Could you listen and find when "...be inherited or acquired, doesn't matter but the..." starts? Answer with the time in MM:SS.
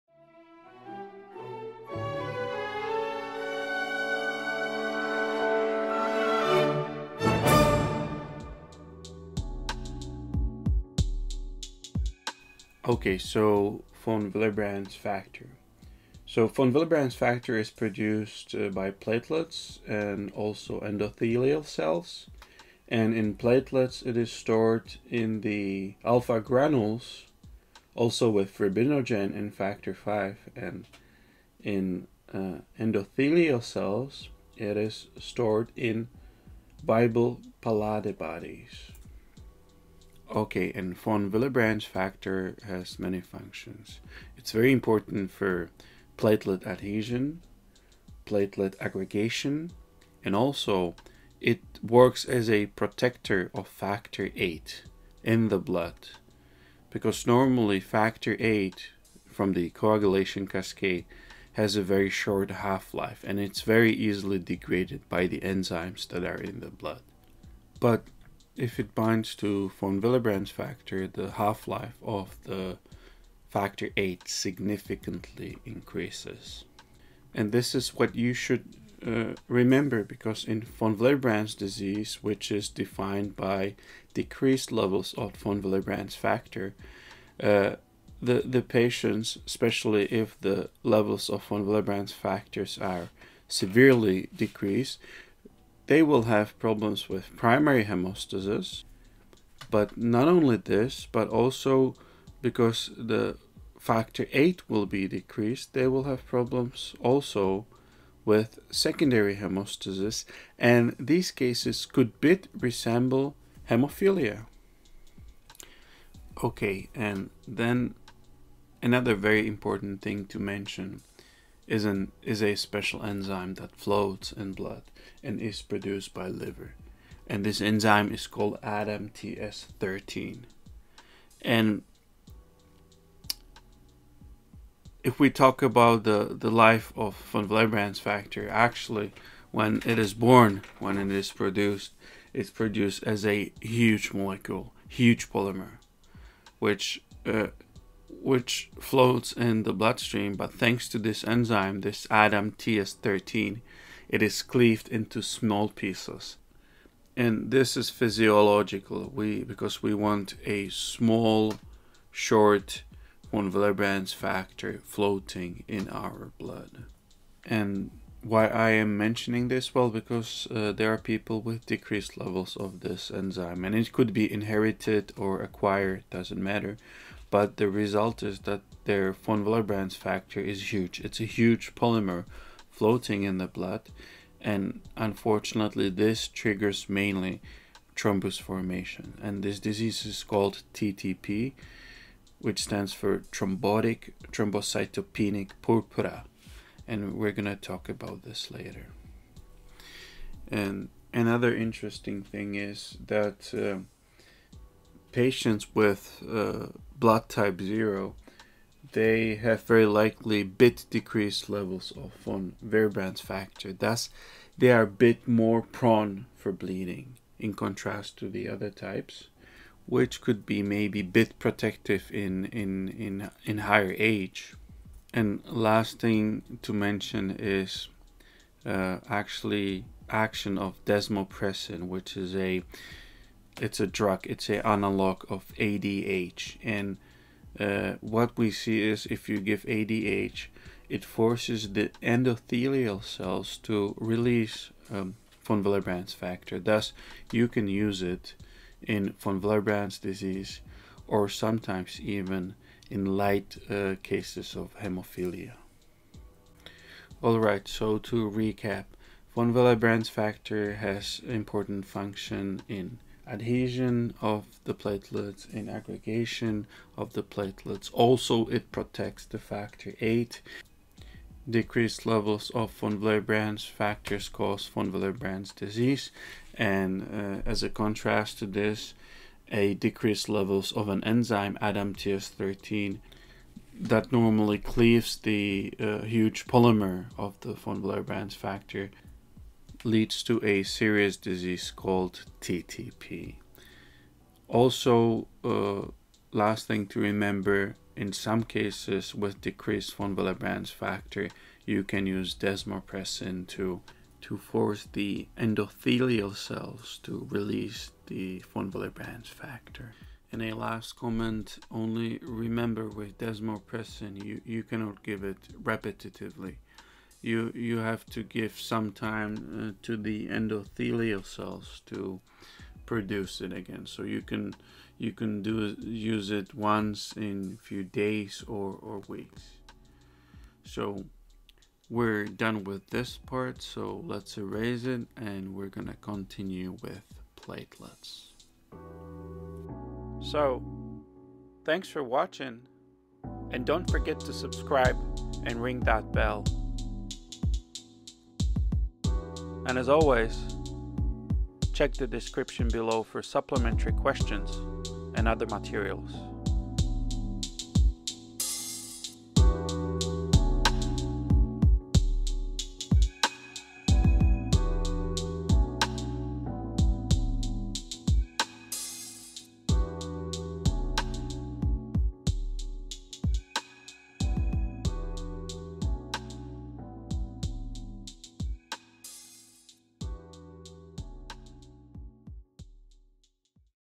02:54.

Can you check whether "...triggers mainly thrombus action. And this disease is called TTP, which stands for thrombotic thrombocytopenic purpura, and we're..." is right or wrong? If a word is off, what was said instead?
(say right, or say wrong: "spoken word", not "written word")
wrong: "formation", not "action".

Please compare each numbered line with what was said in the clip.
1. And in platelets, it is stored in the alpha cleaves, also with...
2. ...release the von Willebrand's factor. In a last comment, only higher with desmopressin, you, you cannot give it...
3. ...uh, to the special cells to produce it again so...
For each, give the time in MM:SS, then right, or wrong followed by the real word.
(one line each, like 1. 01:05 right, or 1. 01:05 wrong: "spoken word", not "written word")
1. 00:22 wrong: "granules", not "cleaves"
2. 05:07 wrong: "remember", not "higher"
3. 05:19 wrong: "endothelial", not "special".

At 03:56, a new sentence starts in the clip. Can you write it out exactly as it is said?
And uh, what we see is if you give ADH, it forces the endothelial cells to release um, von Willebrand's factor.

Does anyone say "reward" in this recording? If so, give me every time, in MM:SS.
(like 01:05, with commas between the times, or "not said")
not said.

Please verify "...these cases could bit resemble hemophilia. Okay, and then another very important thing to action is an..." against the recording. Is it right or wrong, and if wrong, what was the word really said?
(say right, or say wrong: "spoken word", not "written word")
wrong: "mention", not "action".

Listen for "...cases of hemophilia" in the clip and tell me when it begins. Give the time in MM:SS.
04:14.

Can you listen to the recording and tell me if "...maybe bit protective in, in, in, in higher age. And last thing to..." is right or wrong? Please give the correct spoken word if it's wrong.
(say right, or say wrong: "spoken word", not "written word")
right.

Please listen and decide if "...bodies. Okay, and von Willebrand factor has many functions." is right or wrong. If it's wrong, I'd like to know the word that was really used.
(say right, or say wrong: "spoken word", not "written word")
right.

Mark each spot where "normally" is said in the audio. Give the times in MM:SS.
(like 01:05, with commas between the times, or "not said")
00:57, 04:44.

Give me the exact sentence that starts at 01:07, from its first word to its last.
But if it binds to von Willebrand's factor, the half-life of the factor 8 significantly increases.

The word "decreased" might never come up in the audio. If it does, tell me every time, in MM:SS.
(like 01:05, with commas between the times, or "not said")
01:24, 01:34, 01:45, 02:51, 03:30, 04:31, 04:39, 04:59.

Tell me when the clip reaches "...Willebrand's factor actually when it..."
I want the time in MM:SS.
02:17.